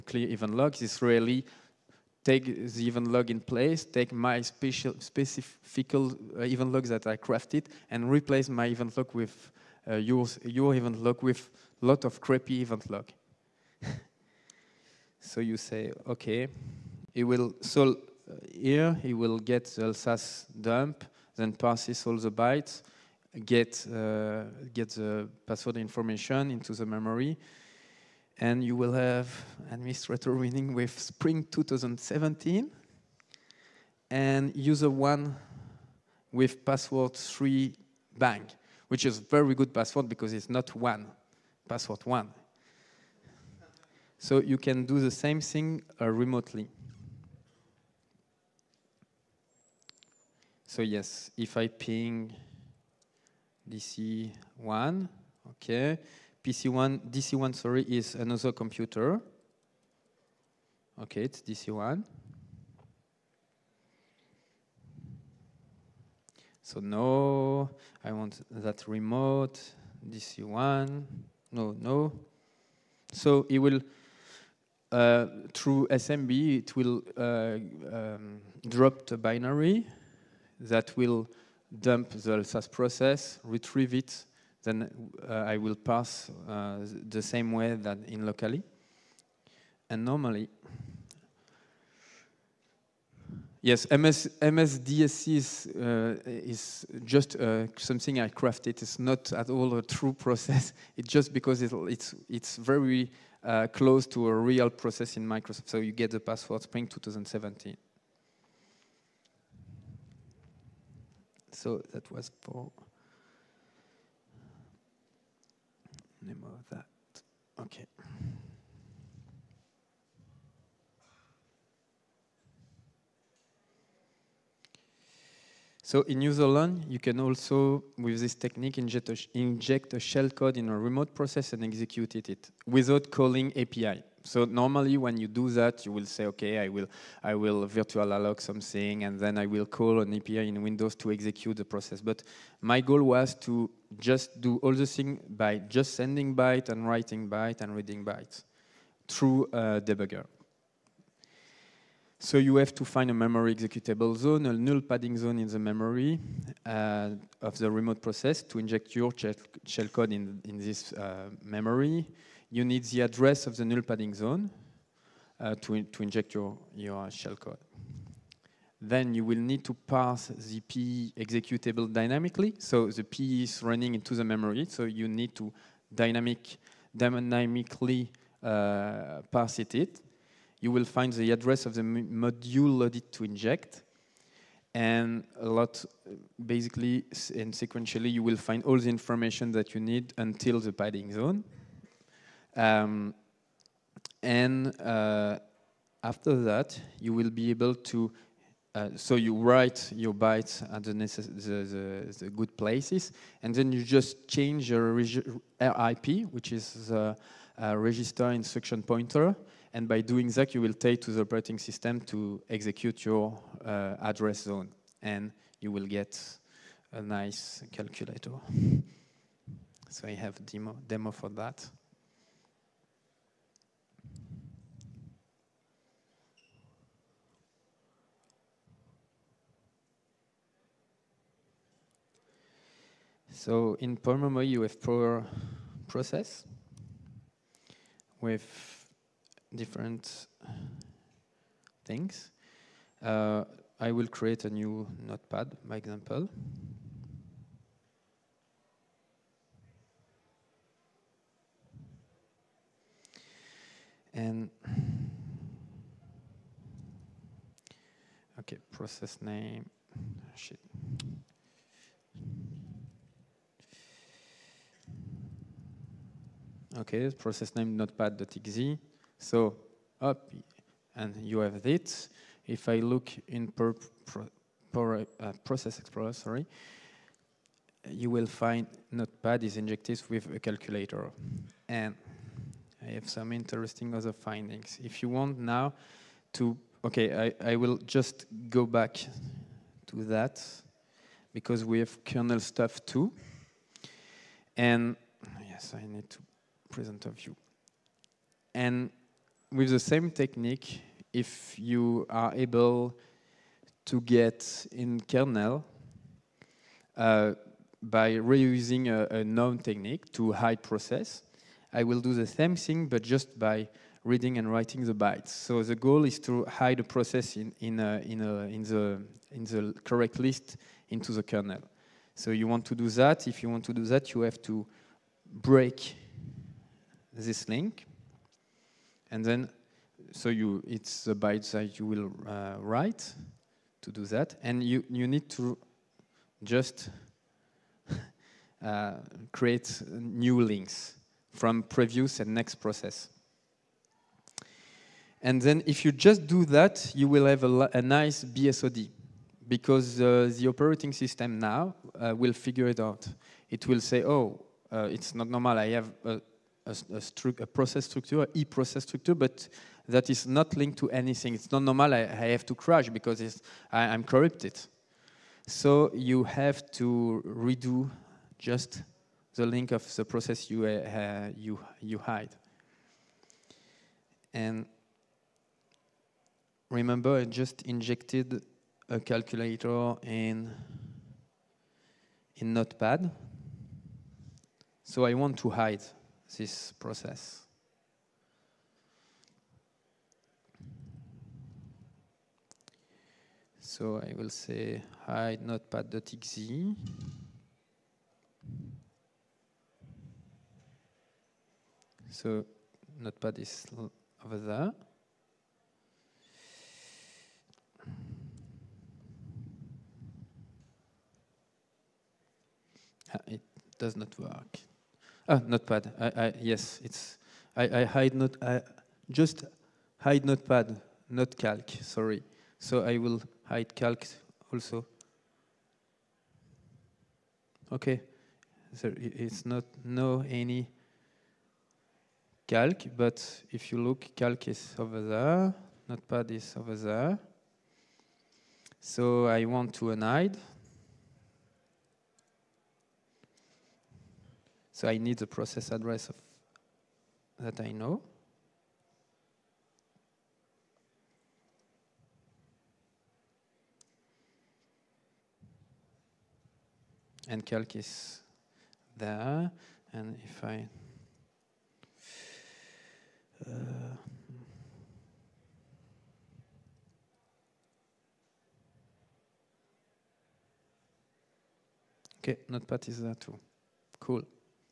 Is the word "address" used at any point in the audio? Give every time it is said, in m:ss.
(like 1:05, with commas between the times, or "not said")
2:43, 3:01, 3:34, 7:25.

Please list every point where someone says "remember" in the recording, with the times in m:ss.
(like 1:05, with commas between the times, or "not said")
6:16.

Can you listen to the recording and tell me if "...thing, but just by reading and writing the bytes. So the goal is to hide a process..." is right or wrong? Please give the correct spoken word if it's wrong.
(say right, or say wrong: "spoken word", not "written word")
right.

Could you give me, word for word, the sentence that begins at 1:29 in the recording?
And normally, yes, MS, MSDSC is, uh, is just uh, something I crafted.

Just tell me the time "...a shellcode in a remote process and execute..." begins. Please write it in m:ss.
2:09.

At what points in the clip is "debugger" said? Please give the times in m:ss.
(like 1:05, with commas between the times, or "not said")
2:29.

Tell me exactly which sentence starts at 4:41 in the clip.
And I have some interesting other findings.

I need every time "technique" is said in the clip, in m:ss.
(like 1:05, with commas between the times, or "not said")
2:08, 5:00, 5:09.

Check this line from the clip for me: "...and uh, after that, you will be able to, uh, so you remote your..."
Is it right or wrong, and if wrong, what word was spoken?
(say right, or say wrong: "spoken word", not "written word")
wrong: "write", not "remote".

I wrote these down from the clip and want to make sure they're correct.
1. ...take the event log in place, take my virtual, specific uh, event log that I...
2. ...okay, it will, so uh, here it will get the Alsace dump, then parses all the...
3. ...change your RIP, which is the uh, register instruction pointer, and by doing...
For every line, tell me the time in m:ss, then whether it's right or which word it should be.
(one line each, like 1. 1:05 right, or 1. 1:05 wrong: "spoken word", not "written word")
1. 0:02 wrong: "special", not "virtual"
2. 0:16 right
3. 3:24 right.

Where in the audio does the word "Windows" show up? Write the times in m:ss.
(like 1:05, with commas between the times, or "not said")
2:20.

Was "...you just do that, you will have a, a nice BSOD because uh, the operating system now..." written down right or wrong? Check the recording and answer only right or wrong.
right.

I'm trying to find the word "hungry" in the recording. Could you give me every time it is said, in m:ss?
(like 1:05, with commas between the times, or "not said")
not said.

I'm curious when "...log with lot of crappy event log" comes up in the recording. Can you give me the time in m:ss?
0:11.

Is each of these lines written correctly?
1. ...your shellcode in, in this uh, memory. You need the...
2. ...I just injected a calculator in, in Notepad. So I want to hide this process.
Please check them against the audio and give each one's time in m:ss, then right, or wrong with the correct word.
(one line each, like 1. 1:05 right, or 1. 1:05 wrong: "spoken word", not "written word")
1. 2:38 right
2. 6:17 right.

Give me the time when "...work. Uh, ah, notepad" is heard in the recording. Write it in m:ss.
6:54.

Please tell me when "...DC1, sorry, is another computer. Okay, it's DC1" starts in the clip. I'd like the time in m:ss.
0:57.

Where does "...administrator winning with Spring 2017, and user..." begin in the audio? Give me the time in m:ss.
0:29.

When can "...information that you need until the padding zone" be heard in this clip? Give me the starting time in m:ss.
3:08.